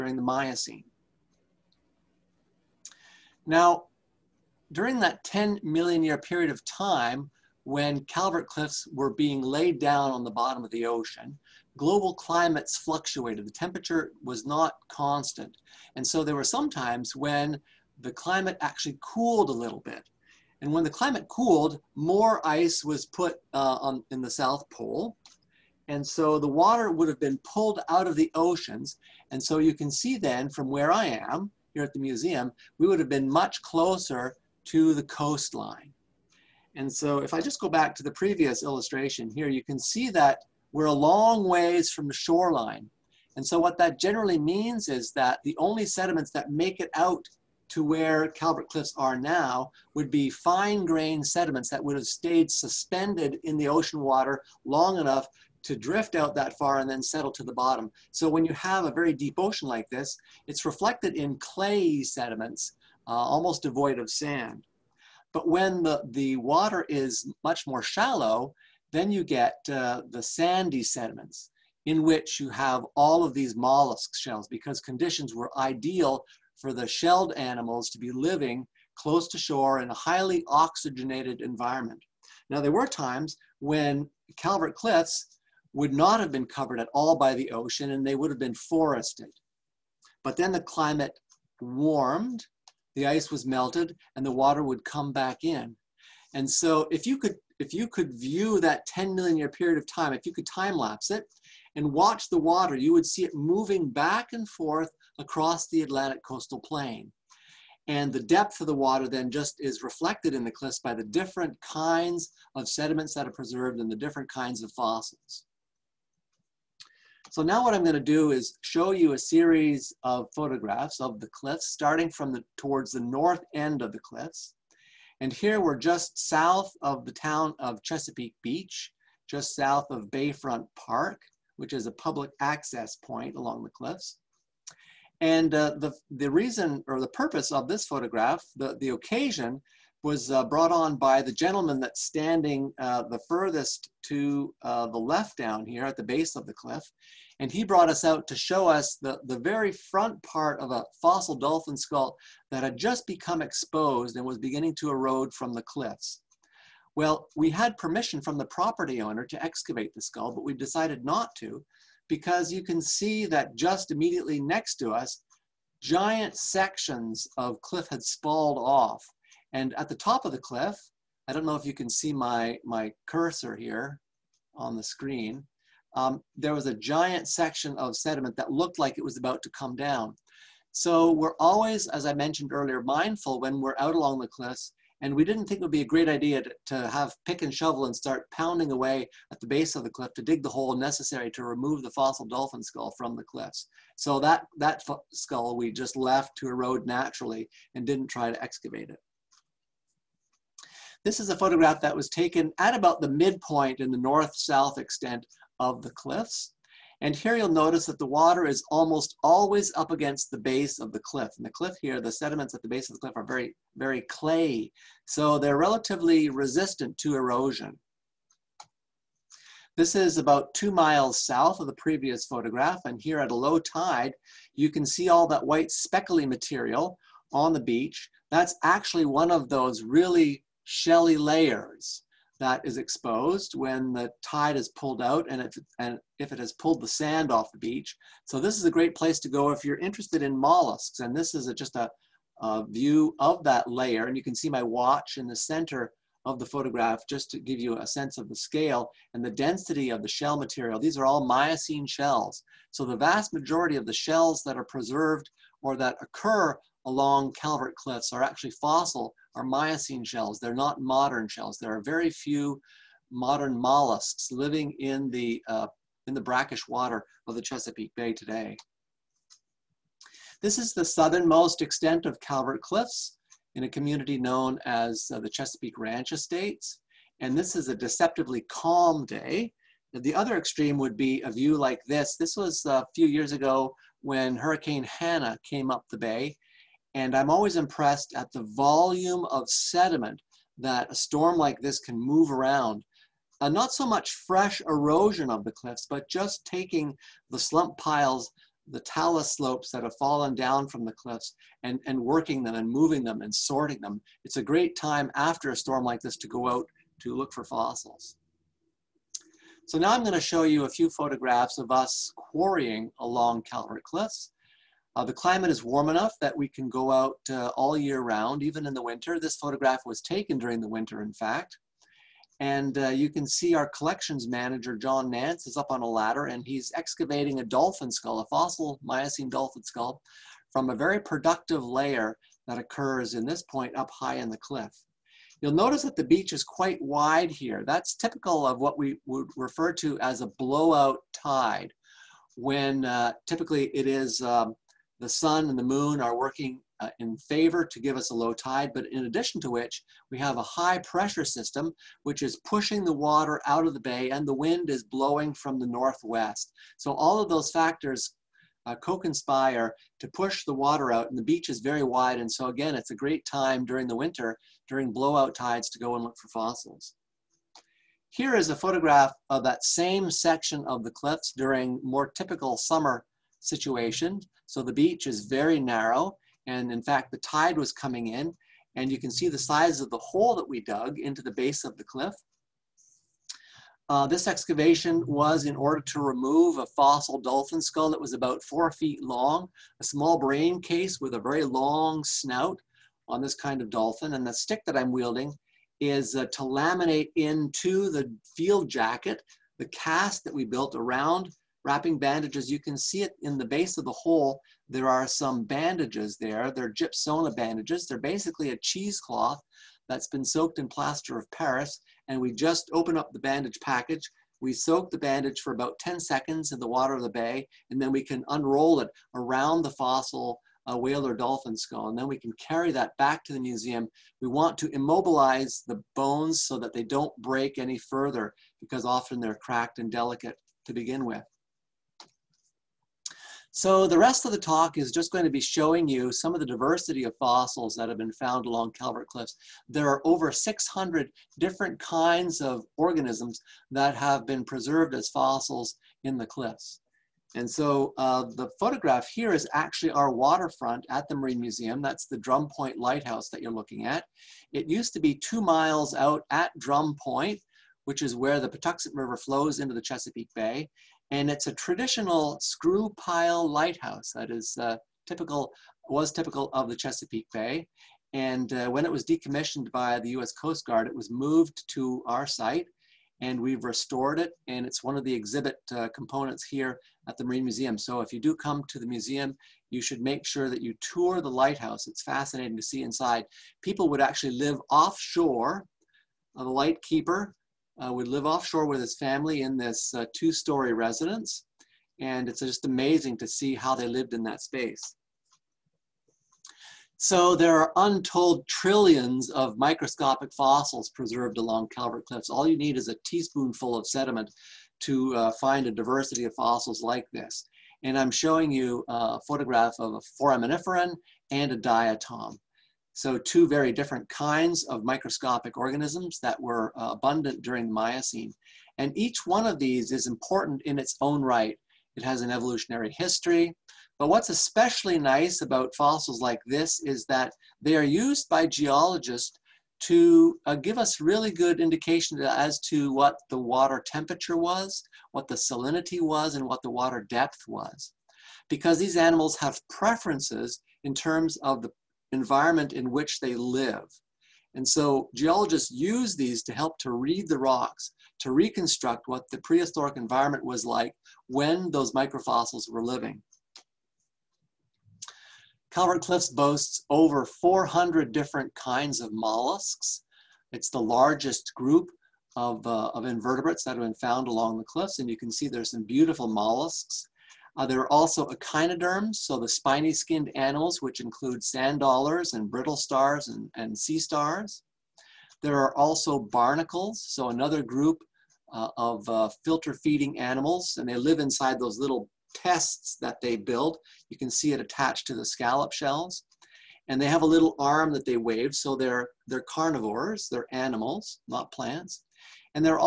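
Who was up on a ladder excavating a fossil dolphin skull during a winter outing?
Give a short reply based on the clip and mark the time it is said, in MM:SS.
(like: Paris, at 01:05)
John Nance, at 05:24.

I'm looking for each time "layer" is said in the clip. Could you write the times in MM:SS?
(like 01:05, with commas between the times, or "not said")
03:51, 04:03, 05:31.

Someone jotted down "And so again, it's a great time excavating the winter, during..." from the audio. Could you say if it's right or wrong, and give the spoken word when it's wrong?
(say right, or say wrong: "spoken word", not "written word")
wrong: "during", not "excavating".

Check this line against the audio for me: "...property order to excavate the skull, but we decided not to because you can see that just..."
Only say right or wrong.
wrong.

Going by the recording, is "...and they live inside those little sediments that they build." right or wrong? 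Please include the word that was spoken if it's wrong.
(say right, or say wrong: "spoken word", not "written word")
wrong: "tests", not "sediments".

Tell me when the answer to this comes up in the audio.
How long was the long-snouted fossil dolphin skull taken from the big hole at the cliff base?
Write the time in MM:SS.
06:28.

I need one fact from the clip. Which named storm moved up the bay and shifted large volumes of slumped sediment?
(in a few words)
Hurricane Hanna.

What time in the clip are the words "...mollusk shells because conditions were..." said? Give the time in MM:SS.
01:13.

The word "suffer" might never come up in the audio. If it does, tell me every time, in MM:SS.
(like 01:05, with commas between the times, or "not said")
not said.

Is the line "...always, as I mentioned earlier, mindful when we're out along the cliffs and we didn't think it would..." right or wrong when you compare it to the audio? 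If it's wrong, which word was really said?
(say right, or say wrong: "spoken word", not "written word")
right.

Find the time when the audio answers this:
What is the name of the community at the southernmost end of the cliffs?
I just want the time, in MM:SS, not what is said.
04:35.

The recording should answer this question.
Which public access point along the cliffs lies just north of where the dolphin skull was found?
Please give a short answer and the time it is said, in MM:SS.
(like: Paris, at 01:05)
Bayfront Park, at 02:10.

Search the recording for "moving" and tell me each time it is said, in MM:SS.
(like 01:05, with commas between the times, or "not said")
01:43, 05:02.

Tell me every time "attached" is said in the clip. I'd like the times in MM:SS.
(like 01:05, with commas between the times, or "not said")
09:44.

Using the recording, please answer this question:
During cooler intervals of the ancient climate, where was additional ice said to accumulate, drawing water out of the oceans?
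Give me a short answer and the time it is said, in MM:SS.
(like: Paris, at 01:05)
South Pole, at 00:24.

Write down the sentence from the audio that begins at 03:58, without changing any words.
So this is a great place to go if you're interested in mollusks.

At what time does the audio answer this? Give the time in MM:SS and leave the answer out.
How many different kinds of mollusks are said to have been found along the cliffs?
09:16.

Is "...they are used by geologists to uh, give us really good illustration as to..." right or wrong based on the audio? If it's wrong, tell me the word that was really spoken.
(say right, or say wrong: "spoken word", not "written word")
wrong: "indication", not "illustration".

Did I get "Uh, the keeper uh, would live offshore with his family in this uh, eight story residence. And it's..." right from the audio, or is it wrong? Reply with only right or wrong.
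wrong.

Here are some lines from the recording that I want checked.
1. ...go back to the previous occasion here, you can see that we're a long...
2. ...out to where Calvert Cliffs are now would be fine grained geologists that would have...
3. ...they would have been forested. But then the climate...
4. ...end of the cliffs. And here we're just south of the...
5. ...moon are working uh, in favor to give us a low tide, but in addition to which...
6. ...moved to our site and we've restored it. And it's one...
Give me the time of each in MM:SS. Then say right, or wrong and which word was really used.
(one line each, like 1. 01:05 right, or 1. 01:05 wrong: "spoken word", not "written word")
1. 00:37 wrong: "illustration", not "occasion"
2. 00:46 wrong: "sediments", not "geologists"
3. 01:28 right
4. 02:03 right
5. 05:45 right
6. 07:51 right.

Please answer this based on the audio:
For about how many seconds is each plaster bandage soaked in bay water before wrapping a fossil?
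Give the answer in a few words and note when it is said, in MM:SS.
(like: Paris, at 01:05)
10 seconds, at 06:55.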